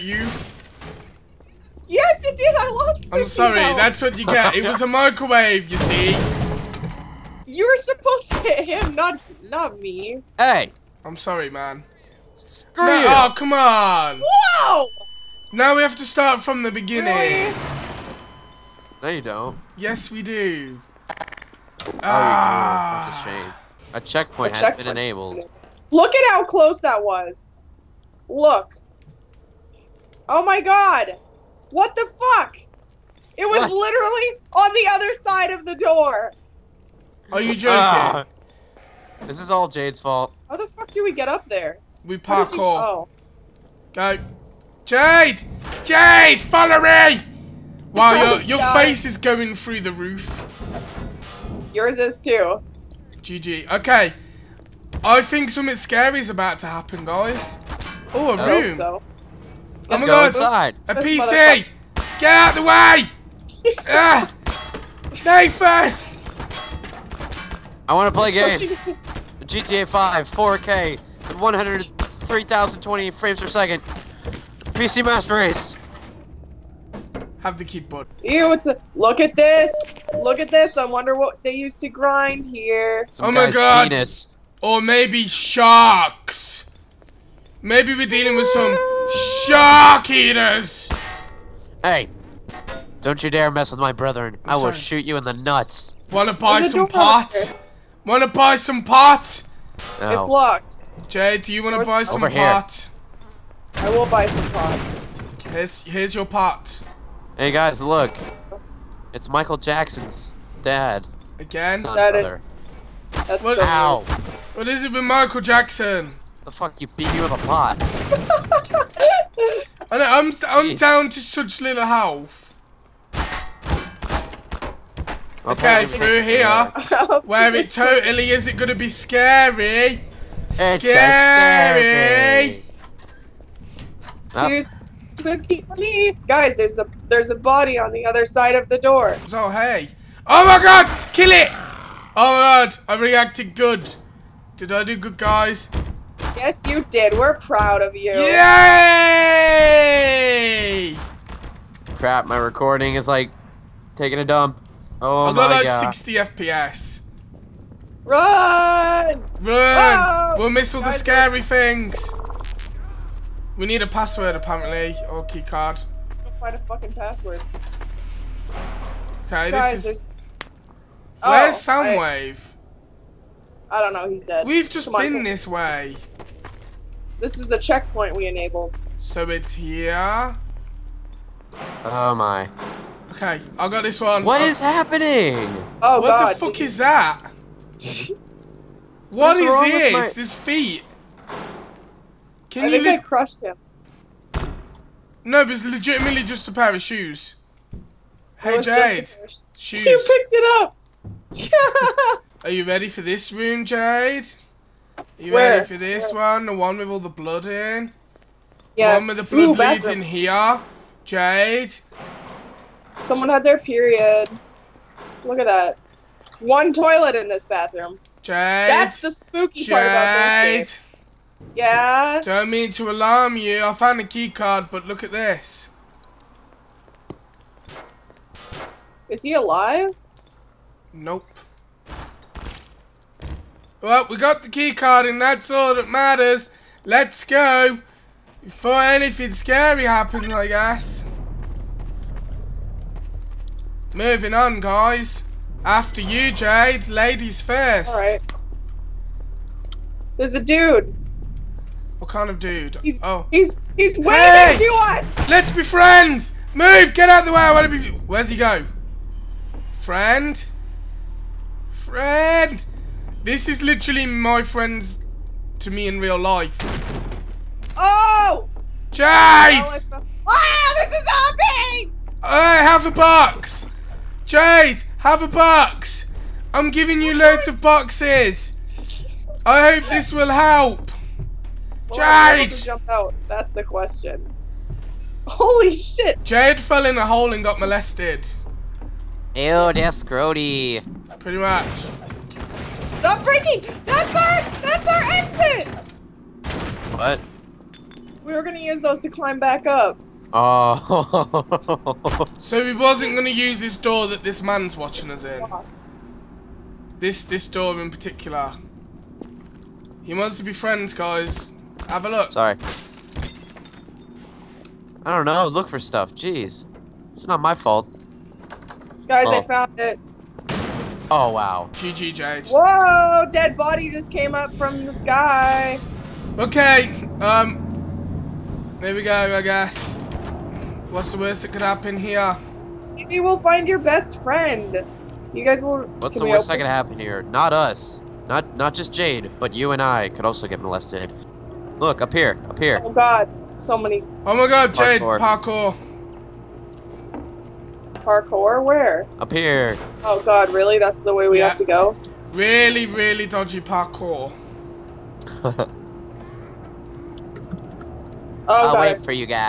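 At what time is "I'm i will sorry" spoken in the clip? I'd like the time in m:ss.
1:34.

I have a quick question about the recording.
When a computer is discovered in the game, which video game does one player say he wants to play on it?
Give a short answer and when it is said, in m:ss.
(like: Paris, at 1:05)
GTA 5, at 1:09.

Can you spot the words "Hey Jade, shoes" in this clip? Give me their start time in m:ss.
3:18.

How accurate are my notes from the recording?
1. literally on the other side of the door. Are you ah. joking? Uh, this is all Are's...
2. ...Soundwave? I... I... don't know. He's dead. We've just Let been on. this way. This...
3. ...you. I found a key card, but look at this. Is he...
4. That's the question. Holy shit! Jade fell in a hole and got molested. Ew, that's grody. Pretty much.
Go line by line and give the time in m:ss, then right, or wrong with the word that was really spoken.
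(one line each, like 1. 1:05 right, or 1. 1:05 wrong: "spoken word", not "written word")
1. 0:33 wrong: "Jade", not "Are"
2. 2:51 wrong: "Come", not "Let"
3. 3:43 right
4. 4:43 right.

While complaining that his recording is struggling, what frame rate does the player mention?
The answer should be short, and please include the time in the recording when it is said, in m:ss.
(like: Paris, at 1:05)
60 FPS, at 2:35.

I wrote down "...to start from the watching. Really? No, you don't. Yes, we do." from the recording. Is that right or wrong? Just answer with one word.
wrong.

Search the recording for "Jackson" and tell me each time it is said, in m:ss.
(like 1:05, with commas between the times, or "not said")
1:49, 1:55.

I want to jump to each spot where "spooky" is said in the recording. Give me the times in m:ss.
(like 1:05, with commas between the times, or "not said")
3:39.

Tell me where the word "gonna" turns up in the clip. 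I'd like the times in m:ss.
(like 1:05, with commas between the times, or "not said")
2:08, 4:58, 5:03.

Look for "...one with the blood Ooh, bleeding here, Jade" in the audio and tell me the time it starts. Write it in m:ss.
3:28.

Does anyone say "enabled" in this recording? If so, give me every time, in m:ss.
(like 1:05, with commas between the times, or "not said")
0:24, 2:58.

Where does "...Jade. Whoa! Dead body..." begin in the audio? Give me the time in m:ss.
5:22.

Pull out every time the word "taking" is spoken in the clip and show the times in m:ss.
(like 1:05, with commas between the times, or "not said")
2:33.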